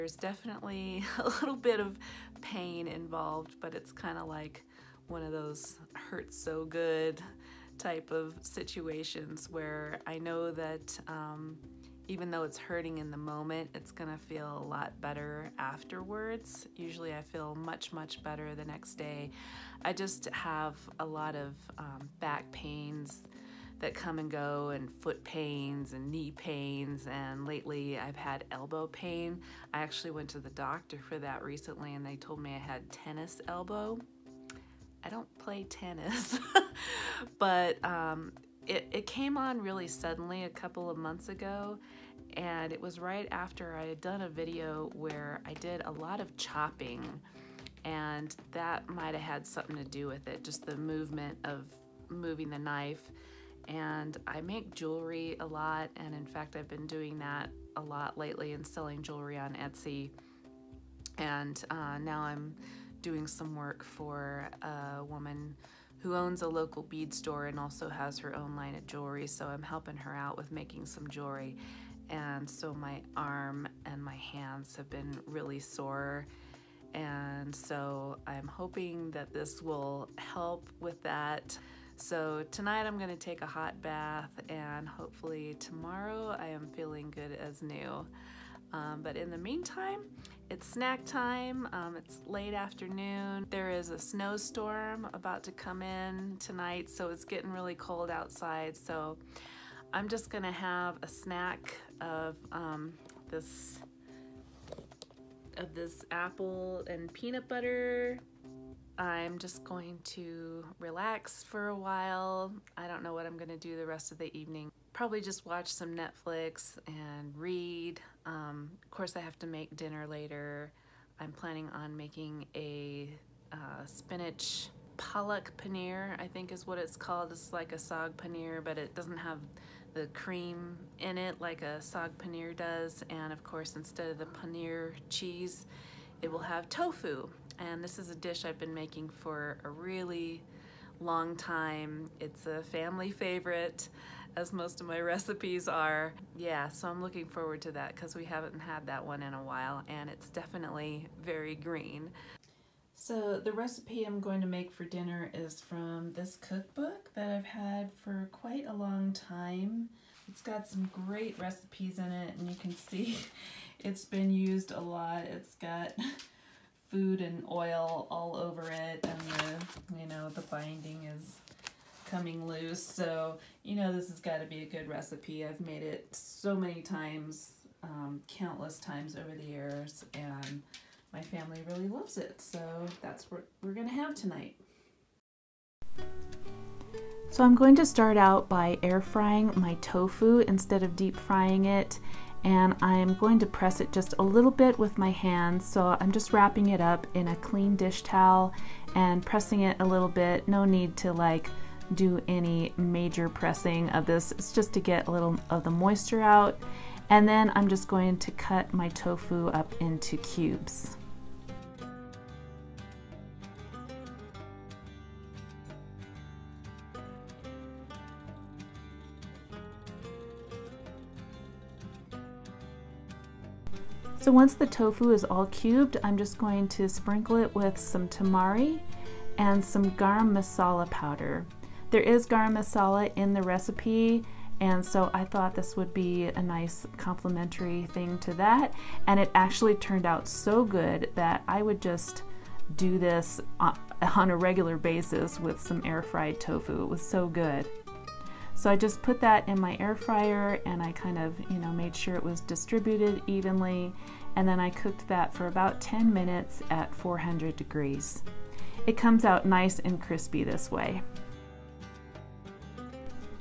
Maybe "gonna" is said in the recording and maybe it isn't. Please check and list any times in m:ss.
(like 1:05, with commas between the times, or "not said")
0:13, 1:40.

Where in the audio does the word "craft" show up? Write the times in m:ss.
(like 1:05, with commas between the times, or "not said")
not said.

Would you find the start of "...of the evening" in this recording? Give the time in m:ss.
1:54.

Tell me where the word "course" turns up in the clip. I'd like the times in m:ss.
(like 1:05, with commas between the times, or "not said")
1:58, 2:13.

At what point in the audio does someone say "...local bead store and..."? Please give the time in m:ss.
1:06.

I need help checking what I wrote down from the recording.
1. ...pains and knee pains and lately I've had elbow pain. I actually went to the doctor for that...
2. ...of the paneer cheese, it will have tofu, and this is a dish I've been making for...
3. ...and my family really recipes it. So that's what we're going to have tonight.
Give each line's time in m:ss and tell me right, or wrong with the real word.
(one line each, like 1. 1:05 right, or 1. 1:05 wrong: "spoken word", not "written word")
1. 0:25 right
2. 2:14 right
3. 3:00 wrong: "loves", not "recipes".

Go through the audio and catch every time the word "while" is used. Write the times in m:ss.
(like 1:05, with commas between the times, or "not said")
1:51, 2:29.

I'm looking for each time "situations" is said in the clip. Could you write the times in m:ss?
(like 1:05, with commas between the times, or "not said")
0:08.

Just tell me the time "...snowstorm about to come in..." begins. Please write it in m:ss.
1:33.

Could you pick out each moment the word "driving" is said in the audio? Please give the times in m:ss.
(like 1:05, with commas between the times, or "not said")
not said.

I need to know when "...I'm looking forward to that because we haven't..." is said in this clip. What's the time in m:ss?
2:26.